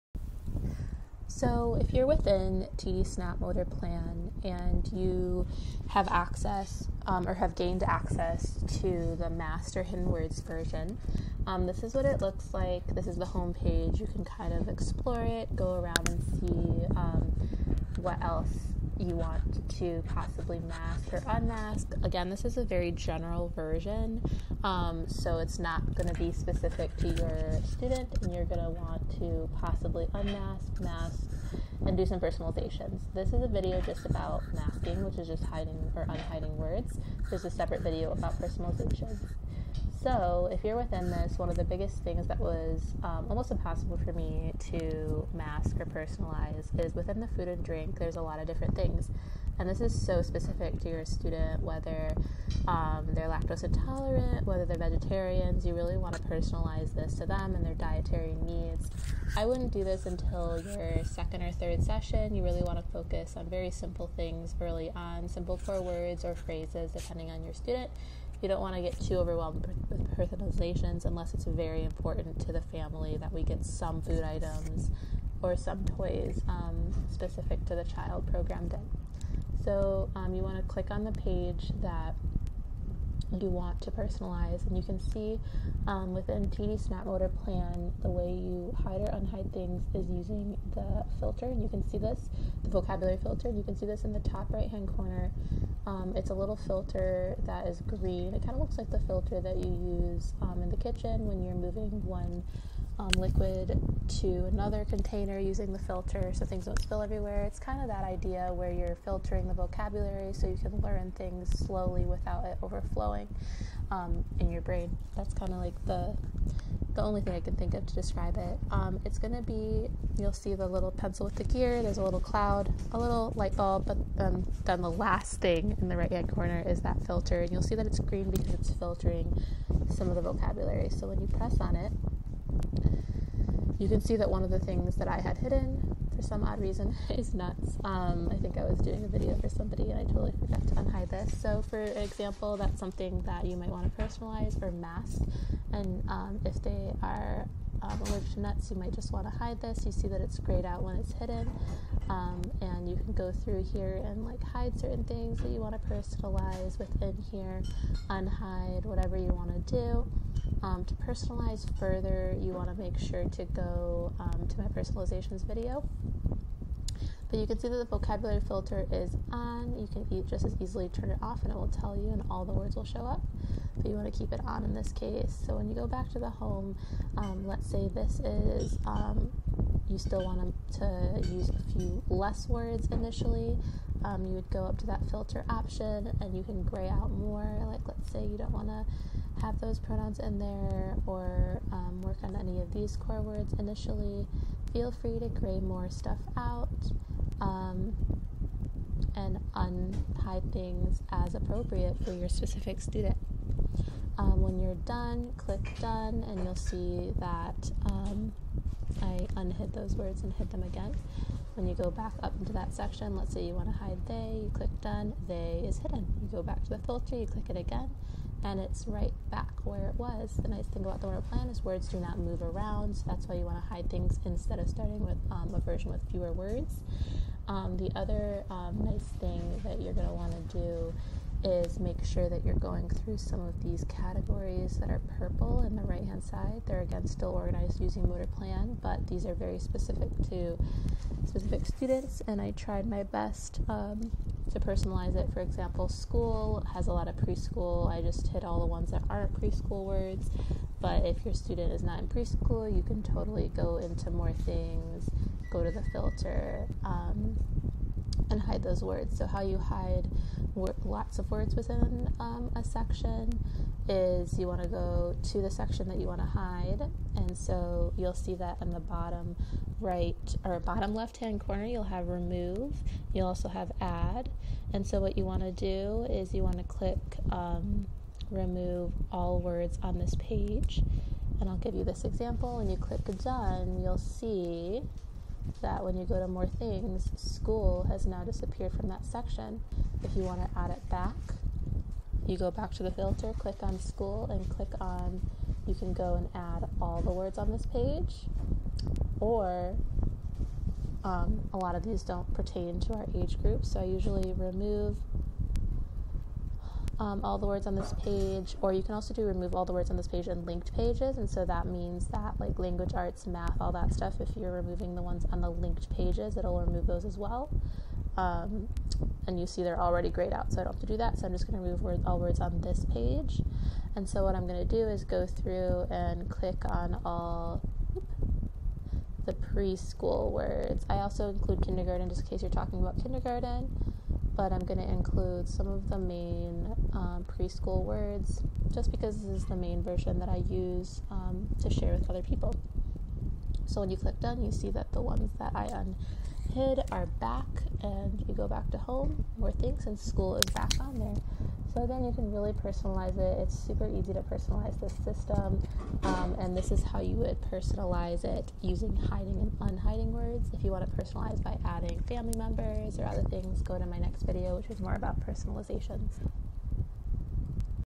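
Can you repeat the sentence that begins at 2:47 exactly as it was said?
But you can see that the vocabulary filter is on.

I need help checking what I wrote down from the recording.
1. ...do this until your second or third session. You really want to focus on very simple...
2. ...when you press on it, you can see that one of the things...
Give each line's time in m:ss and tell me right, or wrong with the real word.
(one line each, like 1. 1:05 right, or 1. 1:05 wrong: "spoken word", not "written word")
1. 0:59 right
2. 2:11 right.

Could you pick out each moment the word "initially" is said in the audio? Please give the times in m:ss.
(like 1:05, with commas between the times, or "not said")
3:02, 3:13.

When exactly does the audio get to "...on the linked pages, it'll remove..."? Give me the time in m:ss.
5:15.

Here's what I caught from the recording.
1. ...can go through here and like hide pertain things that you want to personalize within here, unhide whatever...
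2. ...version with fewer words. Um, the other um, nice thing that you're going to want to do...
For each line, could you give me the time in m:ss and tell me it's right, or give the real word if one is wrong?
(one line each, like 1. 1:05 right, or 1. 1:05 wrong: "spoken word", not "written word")
1. 2:32 wrong: "certain", not "pertain"
2. 3:45 right.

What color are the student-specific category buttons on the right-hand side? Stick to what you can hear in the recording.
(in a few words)
purple.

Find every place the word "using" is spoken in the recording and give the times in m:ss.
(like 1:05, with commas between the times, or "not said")
1:30, 1:45, 3:57, 5:58.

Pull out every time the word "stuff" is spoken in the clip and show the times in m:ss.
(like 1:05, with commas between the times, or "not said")
3:15, 5:13.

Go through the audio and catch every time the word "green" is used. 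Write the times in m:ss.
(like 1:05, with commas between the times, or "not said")
1:37, 2:07.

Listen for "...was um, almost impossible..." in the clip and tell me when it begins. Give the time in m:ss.
0:42.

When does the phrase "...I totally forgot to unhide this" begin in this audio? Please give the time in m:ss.
2:19.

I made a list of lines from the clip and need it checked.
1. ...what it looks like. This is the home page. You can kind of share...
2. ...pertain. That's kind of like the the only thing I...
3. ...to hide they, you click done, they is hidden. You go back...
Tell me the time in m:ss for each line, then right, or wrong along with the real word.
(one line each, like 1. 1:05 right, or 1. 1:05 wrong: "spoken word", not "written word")
1. 0:11 wrong: "explore", not "share"
2. 1:54 wrong: "brain", not "pertain"
3. 3:33 right.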